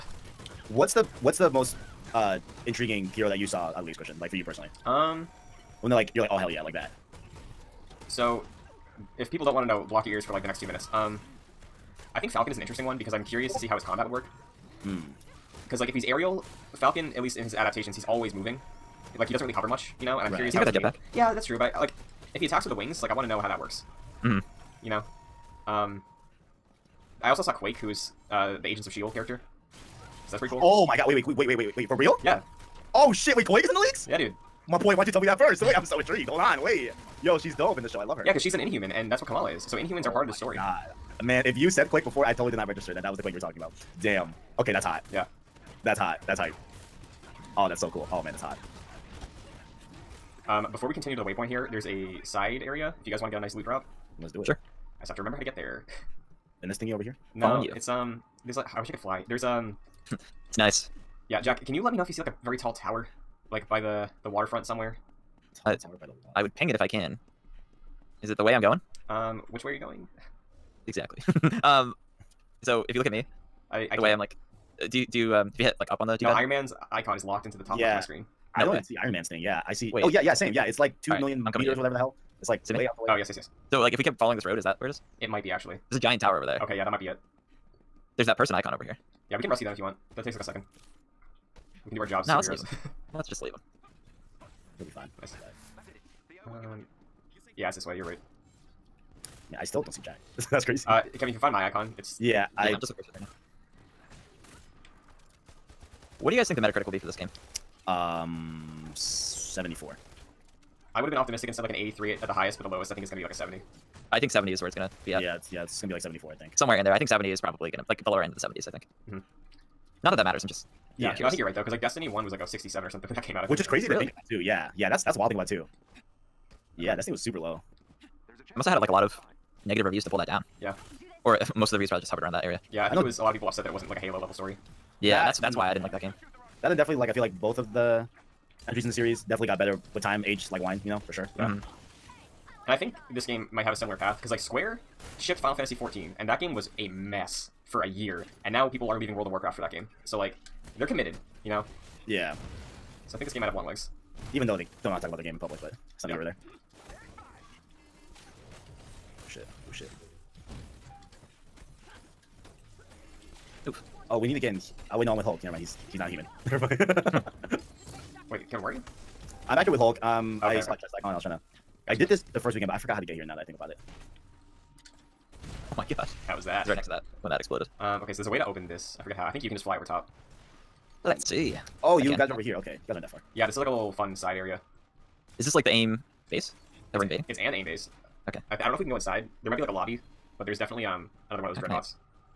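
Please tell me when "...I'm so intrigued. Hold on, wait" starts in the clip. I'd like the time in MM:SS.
00:35.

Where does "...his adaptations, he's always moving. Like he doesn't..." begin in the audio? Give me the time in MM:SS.
00:17.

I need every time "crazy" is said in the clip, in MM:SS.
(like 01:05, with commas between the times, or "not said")
01:40, 02:03.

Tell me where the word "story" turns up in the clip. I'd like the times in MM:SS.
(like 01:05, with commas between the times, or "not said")
00:40, 02:14.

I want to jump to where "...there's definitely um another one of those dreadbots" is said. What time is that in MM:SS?
03:10.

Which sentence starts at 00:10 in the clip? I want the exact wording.
Um, I think Falcon is an interesting one because I'm curious to see how his combat would work.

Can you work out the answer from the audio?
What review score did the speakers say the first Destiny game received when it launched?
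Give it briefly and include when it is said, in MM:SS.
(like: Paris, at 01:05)
67, at 02:02.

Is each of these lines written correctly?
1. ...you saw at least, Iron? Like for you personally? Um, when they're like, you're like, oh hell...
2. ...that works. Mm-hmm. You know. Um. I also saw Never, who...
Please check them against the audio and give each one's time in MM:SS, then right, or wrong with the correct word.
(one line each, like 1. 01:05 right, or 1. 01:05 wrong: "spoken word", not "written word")
1. 00:03 wrong: "Christian", not "Iron"
2. 00:23 wrong: "Quake", not "Never".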